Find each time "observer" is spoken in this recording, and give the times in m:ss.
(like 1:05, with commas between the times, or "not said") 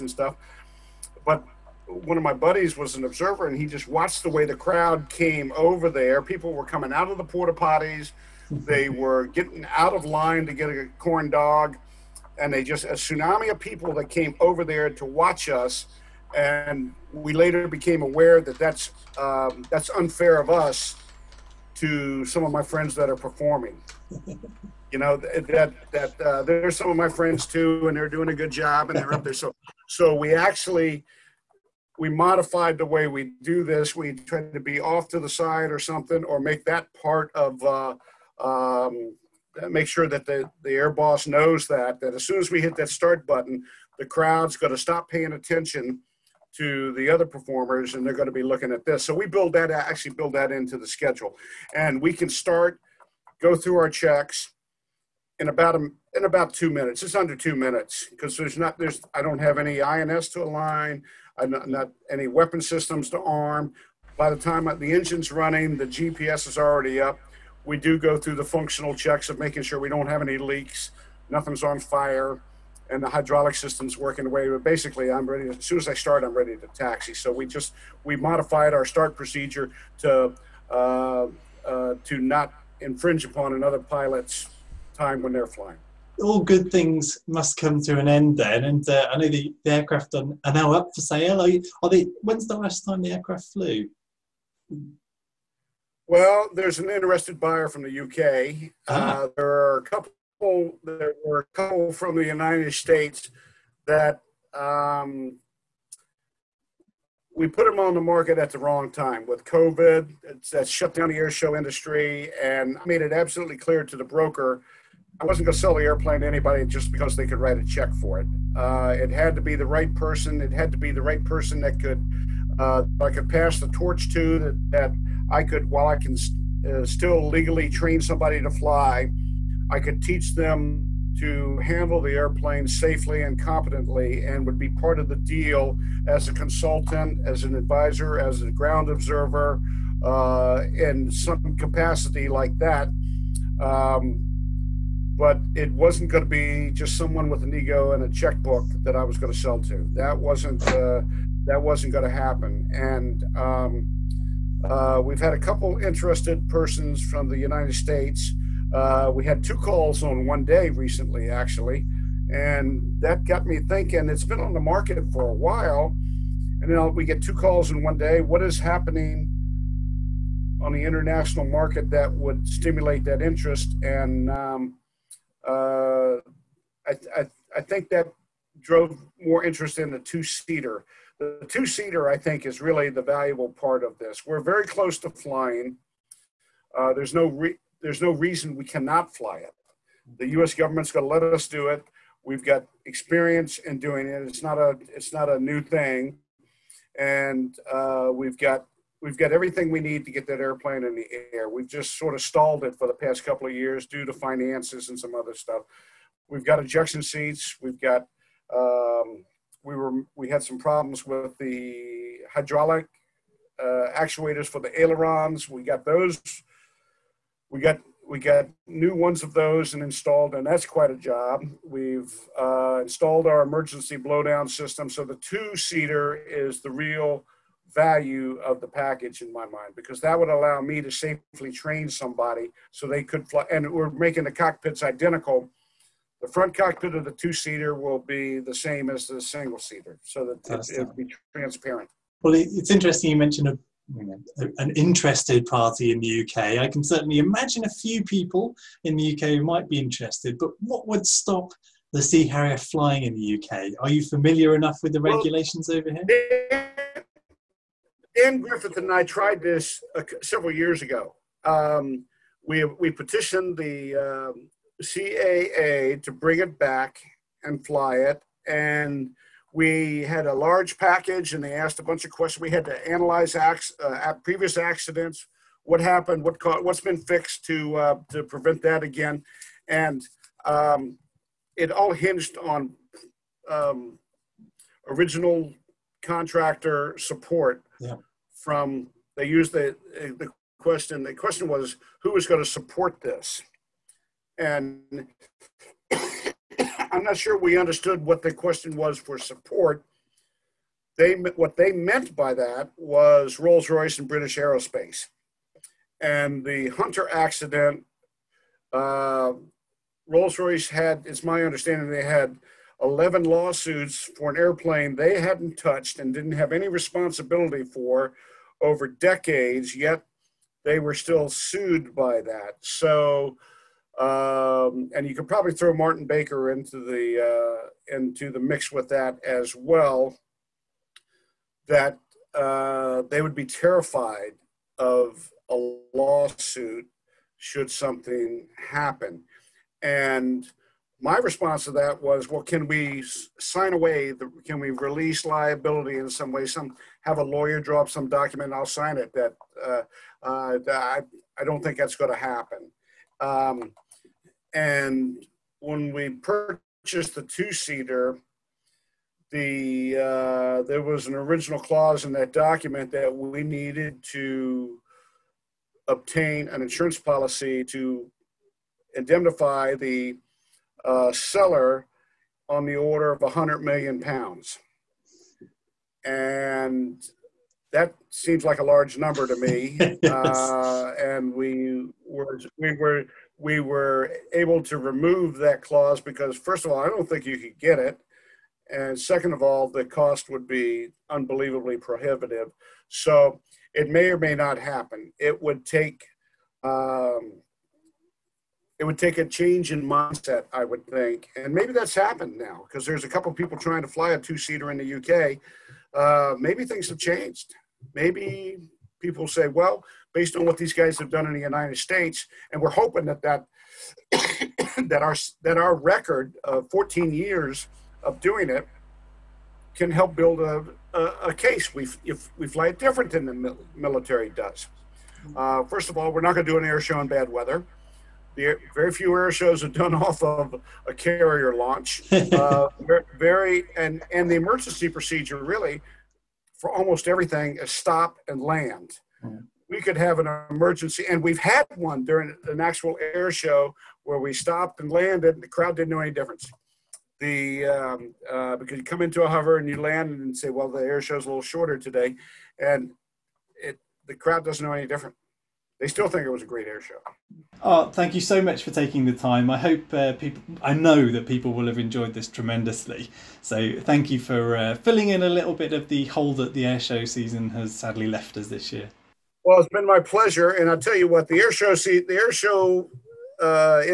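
0:03, 2:18.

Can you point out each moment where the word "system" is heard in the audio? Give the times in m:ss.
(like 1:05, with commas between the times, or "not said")
1:02, 1:13, 3:44.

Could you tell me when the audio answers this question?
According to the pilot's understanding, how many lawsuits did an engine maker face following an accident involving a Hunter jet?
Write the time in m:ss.
5:12.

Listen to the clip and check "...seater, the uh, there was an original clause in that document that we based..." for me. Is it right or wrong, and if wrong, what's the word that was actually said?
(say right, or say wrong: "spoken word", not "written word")
wrong: "needed", not "based".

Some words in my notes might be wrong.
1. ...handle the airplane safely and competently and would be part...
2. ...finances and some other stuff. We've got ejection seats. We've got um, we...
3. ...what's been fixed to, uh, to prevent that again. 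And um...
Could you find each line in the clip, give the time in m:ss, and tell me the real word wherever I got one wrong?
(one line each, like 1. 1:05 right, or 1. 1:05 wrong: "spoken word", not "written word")
1. 2:11 right
2. 3:24 right
3. 4:36 right.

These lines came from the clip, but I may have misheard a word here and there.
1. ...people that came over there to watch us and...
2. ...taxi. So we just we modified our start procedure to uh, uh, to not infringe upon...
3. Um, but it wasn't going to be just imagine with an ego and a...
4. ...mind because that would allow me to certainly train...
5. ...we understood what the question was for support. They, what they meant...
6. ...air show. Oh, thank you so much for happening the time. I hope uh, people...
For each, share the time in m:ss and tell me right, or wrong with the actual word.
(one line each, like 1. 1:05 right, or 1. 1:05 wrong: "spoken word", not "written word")
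1. 0:13 right
2. 1:16 right
3. 2:23 wrong: "someone", not "imagine"
4. 3:49 wrong: "safely", not "certainly"
5. 4:57 right
6. 7:36 wrong: "taking", not "happening".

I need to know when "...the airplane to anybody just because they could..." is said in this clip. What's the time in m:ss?
1:55.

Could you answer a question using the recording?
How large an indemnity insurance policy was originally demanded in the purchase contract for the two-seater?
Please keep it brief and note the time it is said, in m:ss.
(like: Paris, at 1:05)
100 million pounds, at 6:13.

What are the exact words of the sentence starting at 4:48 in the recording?
from, they used the, the question, the question was who was going to support this?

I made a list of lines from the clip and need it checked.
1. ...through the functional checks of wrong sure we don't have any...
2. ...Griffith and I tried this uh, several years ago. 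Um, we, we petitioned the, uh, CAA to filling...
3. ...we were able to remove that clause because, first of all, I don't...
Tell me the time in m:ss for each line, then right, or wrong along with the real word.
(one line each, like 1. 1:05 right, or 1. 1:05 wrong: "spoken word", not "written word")
1. 1:08 wrong: "making", not "wrong"
2. 4:18 wrong: "bring", not "filling"
3. 6:23 right.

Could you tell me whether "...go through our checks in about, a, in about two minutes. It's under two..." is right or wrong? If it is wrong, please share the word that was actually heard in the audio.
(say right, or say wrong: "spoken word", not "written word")
right.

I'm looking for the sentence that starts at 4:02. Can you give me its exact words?
Well, it's interesting you mentioned a, an interested party in the UK.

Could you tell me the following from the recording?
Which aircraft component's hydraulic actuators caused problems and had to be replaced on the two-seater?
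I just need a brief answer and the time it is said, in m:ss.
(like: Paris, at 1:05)
Ailerons, at 3:34.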